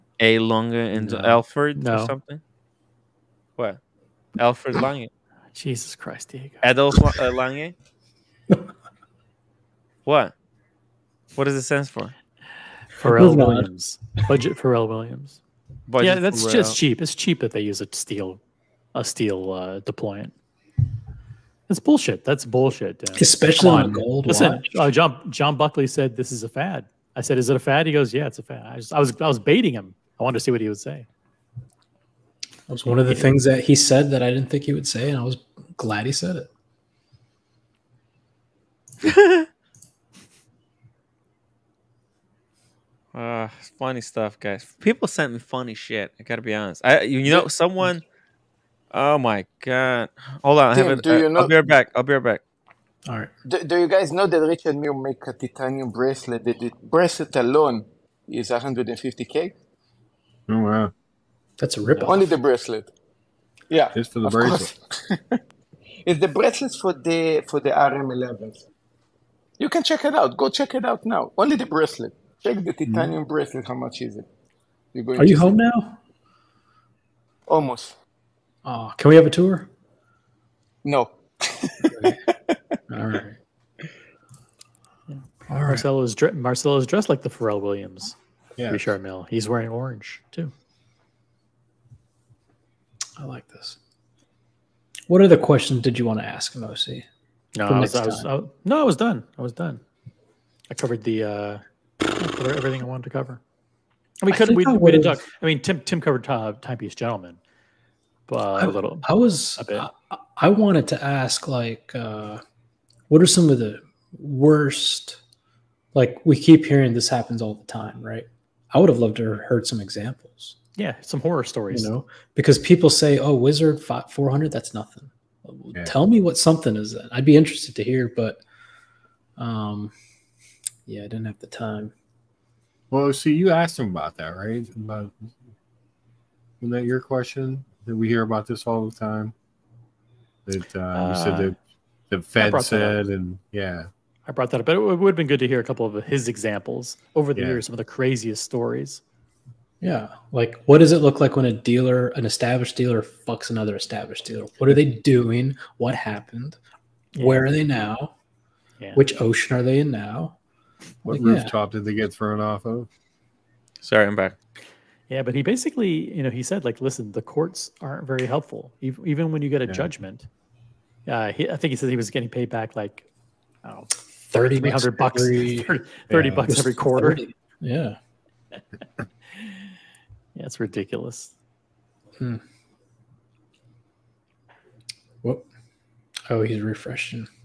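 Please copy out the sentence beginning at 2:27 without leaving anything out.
years, some of the craziest stories.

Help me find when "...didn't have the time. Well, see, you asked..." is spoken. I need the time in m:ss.
2:11.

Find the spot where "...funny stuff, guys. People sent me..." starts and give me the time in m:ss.
0:43.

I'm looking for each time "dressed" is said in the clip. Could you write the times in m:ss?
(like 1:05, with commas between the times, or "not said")
1:26.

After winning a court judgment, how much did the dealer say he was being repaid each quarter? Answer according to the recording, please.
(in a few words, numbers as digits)
30 bucks.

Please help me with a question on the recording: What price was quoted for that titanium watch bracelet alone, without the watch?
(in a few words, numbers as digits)
150k.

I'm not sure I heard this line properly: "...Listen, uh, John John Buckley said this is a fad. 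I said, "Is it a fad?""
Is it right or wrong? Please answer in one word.
right.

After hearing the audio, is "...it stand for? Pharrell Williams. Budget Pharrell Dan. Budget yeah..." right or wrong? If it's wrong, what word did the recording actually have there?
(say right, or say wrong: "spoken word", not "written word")
wrong: "Williams", not "Dan".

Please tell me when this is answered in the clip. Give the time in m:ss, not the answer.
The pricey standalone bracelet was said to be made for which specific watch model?
1:07.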